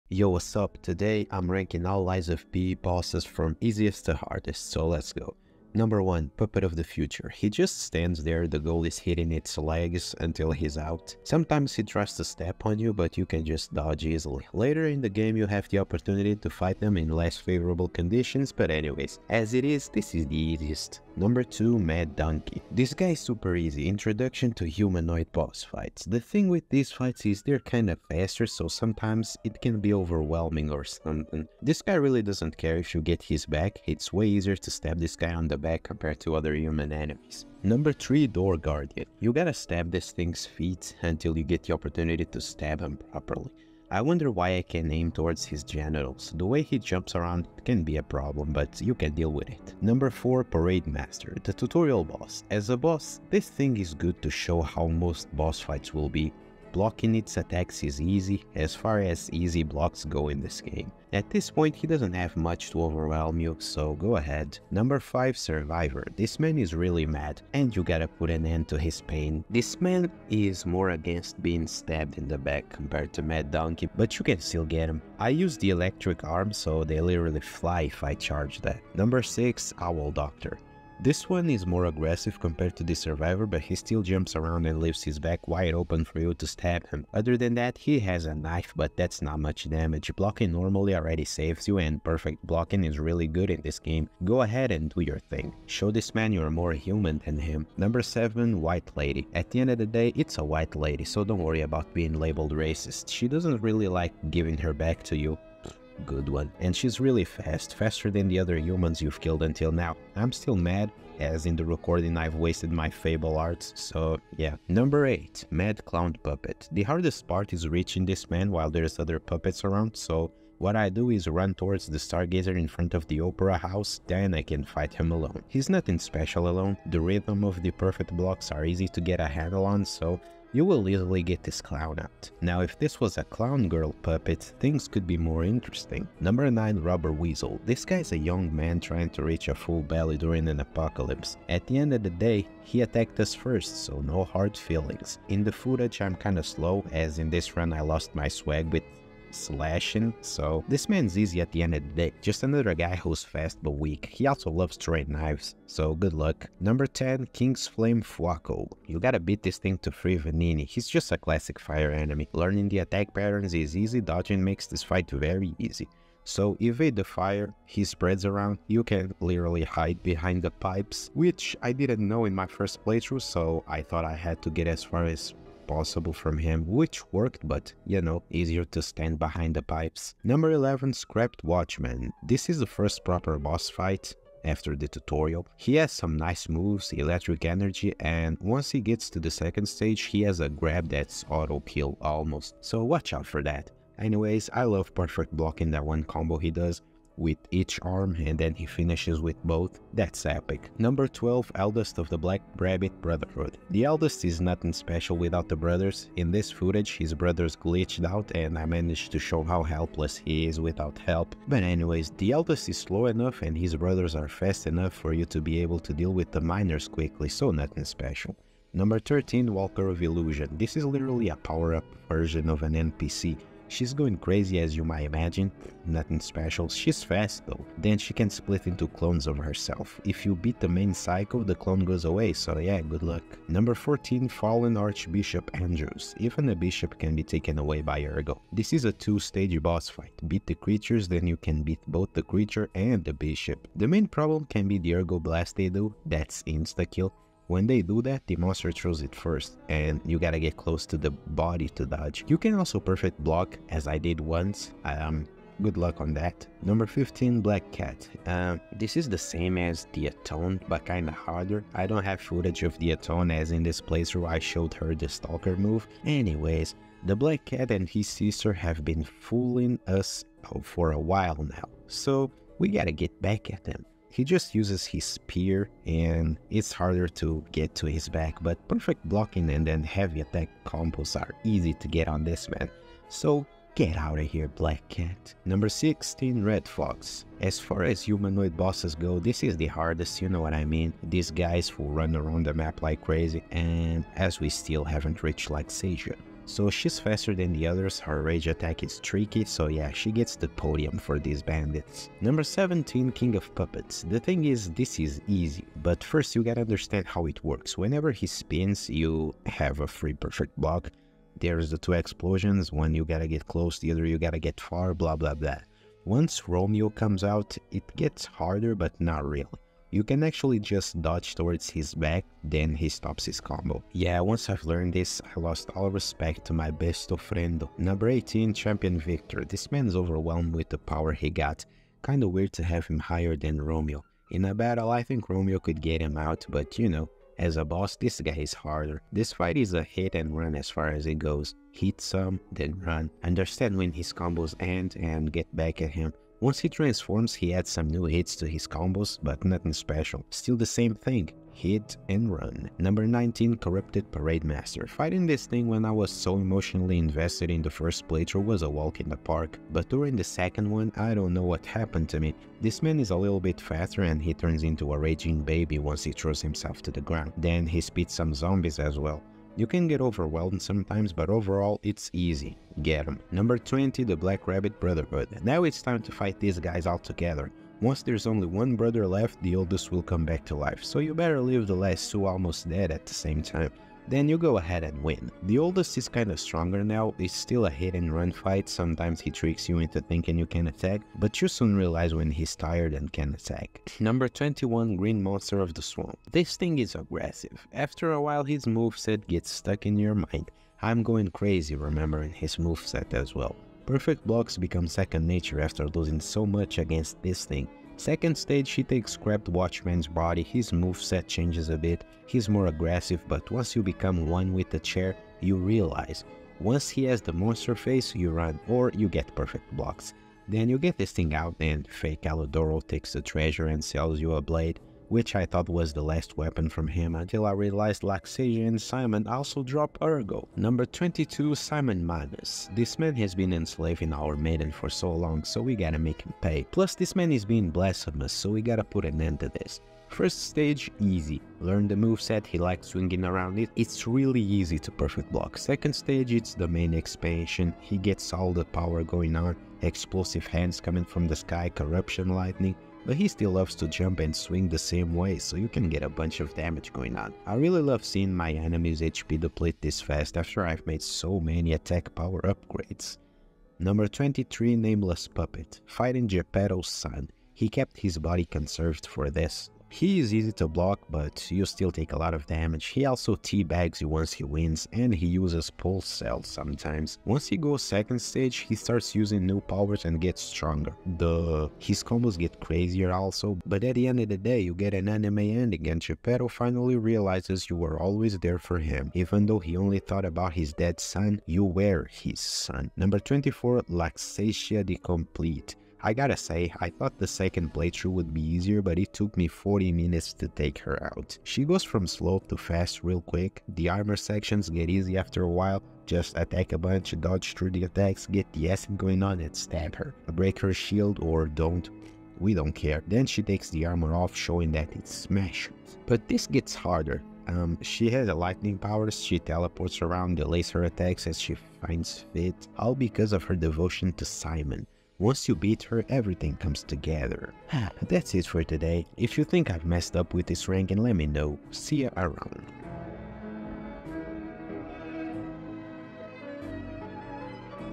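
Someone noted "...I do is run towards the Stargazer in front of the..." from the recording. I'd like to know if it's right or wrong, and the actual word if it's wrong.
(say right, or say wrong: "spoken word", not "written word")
right.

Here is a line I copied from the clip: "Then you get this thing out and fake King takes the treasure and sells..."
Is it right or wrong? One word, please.
wrong.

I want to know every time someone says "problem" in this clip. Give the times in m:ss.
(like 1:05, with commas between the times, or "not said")
0:48, 4:04.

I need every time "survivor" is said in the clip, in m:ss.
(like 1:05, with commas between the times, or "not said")
1:05, 1:22.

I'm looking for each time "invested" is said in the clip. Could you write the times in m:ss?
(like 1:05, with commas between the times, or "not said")
5:56.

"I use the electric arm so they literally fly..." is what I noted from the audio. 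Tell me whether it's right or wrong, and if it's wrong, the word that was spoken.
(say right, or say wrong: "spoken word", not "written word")
right.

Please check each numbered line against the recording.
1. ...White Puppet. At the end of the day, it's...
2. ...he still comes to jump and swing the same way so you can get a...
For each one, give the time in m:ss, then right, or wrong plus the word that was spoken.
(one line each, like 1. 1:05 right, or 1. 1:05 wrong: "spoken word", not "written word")
1. 1:38 wrong: "Lady", not "Puppet"
2. 7:33 wrong: "loves", not "comes".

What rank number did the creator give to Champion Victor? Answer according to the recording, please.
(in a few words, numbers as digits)
18.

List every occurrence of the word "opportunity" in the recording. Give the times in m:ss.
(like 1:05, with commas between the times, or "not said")
0:15, 0:41.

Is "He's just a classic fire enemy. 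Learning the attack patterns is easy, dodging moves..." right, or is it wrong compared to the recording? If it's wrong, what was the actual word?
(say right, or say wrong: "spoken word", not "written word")
wrong: "makes", not "moves".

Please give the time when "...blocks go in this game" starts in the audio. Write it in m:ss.
0:59.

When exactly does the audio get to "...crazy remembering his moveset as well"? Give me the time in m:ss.
6:41.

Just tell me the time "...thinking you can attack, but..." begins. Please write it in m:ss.
6:30.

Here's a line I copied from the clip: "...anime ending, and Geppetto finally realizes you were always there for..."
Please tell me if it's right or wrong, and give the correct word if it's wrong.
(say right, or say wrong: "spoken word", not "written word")
right.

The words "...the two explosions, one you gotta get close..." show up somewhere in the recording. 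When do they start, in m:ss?
5:11.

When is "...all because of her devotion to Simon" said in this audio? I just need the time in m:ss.
8:42.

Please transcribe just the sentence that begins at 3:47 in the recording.
Then she can split into clones of herself.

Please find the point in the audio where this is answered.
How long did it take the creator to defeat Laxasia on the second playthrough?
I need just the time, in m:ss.
8:19.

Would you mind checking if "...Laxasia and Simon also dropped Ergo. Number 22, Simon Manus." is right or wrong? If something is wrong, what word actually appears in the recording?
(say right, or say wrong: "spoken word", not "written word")
right.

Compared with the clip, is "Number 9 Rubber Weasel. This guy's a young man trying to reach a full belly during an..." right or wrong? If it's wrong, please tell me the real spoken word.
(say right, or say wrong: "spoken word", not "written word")
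right.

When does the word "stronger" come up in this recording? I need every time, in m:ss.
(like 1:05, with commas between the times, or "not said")
6:26, 8:00.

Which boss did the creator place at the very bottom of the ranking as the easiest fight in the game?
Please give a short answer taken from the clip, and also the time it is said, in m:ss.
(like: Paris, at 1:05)
Puppet of the Future, at 0:06.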